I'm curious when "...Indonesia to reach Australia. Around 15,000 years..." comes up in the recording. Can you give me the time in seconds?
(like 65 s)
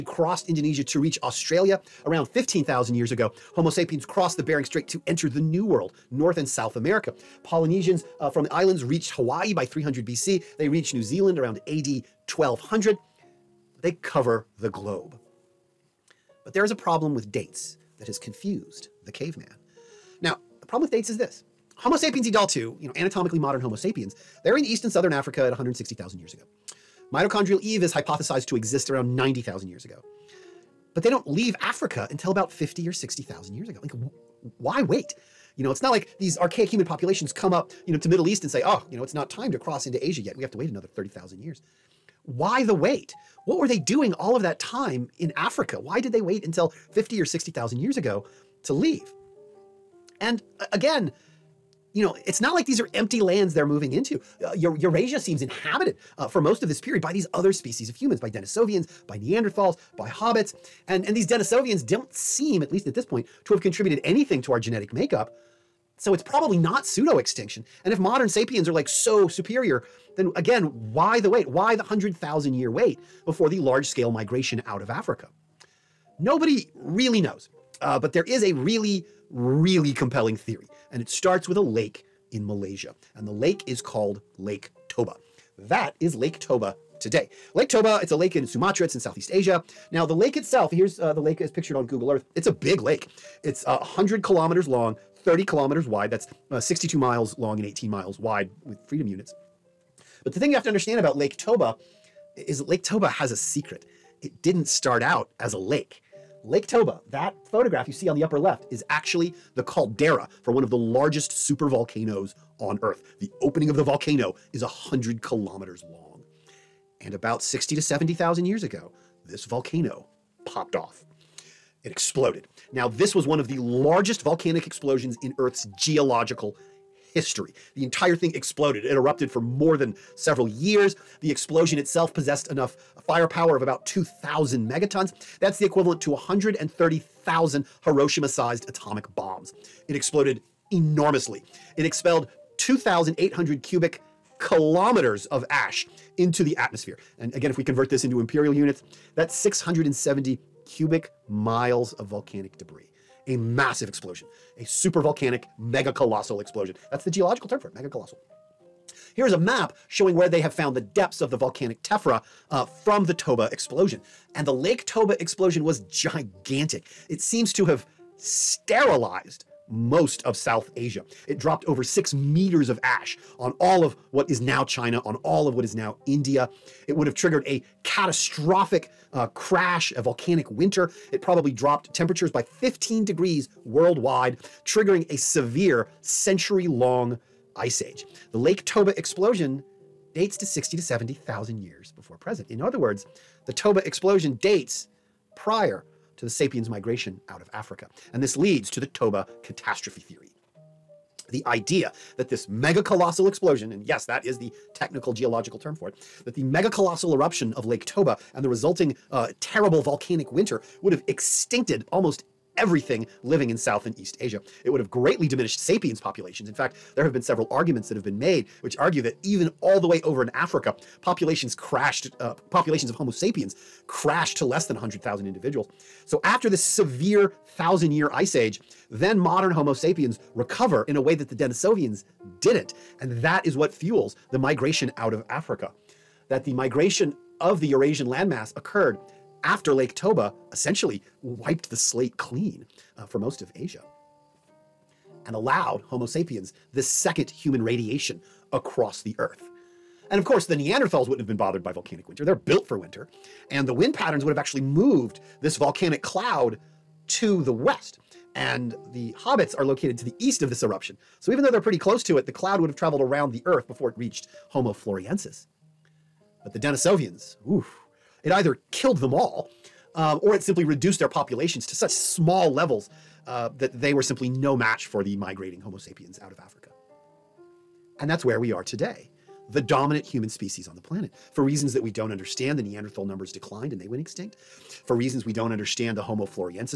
0 s.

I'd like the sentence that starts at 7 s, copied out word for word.
Polynesians uh, from the islands reached Hawaii by 300 BC.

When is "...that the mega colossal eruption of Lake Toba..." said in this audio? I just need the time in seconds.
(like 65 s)
206 s.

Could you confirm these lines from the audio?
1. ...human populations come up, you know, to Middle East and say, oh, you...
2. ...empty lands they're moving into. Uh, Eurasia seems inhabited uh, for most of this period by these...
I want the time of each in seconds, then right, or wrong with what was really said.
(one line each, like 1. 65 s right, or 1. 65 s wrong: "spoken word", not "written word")
1. 36 s right
2. 52 s right.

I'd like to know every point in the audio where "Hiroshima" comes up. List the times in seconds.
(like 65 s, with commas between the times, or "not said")
137 s.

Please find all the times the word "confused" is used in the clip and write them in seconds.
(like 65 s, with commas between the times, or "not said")
18 s.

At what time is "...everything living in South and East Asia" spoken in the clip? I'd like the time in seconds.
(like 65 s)
212 s.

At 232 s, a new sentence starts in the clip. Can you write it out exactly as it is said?
And that is what fuels the migration out of Africa.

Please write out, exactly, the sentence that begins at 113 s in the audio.
The opening of the volcano is 100 kilometers long.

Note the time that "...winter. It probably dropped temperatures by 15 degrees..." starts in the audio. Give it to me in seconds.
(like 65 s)
180 s.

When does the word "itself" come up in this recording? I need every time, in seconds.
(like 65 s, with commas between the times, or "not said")
90 s, 131 s.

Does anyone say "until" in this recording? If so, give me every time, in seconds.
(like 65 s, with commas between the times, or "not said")
32 s, 46 s.